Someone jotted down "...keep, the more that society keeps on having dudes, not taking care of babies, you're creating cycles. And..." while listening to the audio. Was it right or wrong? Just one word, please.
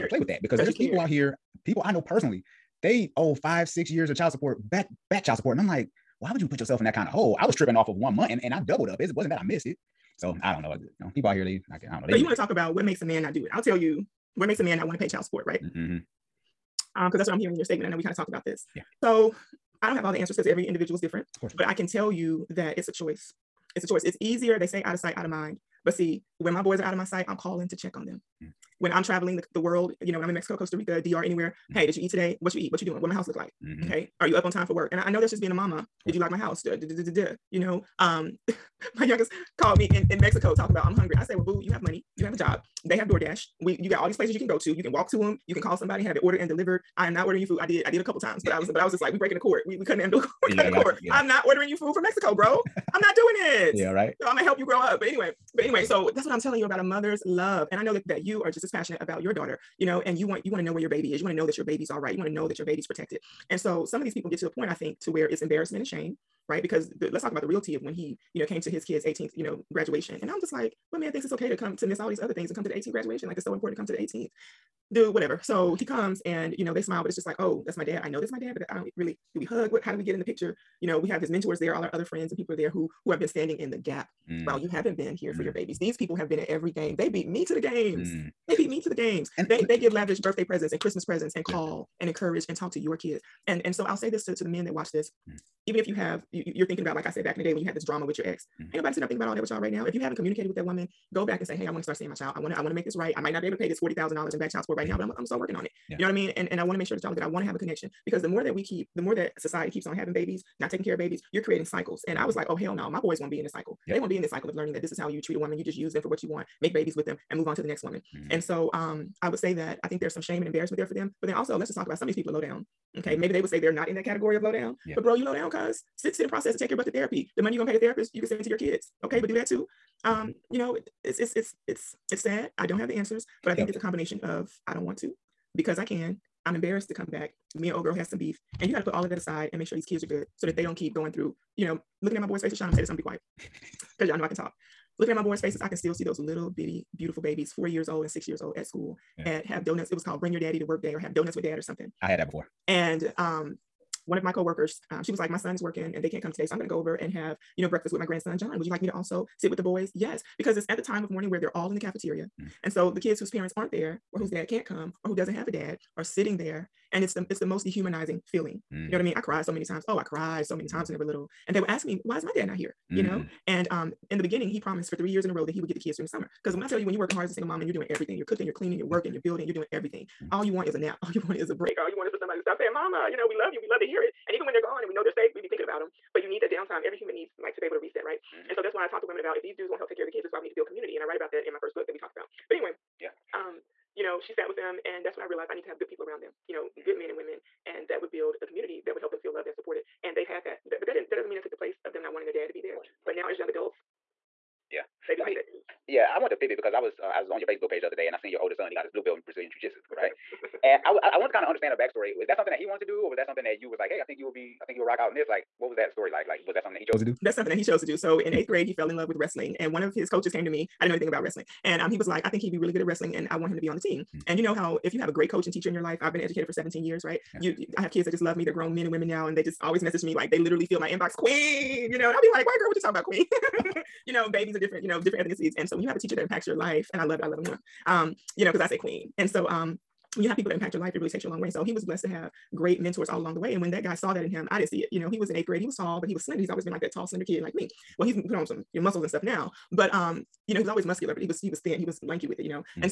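wrong.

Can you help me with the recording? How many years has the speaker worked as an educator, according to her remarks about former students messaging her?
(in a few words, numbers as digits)
17.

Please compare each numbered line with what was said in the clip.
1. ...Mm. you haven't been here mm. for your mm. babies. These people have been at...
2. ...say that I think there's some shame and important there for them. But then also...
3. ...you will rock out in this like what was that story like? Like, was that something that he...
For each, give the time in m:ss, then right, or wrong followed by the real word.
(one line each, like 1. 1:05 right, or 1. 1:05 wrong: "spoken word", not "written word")
1. 1:24 right
2. 1:59 wrong: "embarrassment", not "important"
3. 3:34 right.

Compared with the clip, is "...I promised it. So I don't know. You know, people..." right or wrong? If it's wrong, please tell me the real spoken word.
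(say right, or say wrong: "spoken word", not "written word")
wrong: "missed", not "promised".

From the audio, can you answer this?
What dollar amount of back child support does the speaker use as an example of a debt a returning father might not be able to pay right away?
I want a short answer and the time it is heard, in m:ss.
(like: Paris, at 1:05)
$40,000, at 1:43.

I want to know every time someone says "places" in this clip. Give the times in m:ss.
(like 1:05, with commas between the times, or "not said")
0:44, 3:21.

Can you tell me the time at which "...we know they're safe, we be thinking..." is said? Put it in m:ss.
3:04.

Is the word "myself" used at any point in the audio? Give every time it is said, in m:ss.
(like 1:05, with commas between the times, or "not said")
not said.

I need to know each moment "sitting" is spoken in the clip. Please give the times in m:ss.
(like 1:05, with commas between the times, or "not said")
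1:38, 2:46.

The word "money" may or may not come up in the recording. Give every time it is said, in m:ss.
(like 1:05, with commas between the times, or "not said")
0:41, 2:07.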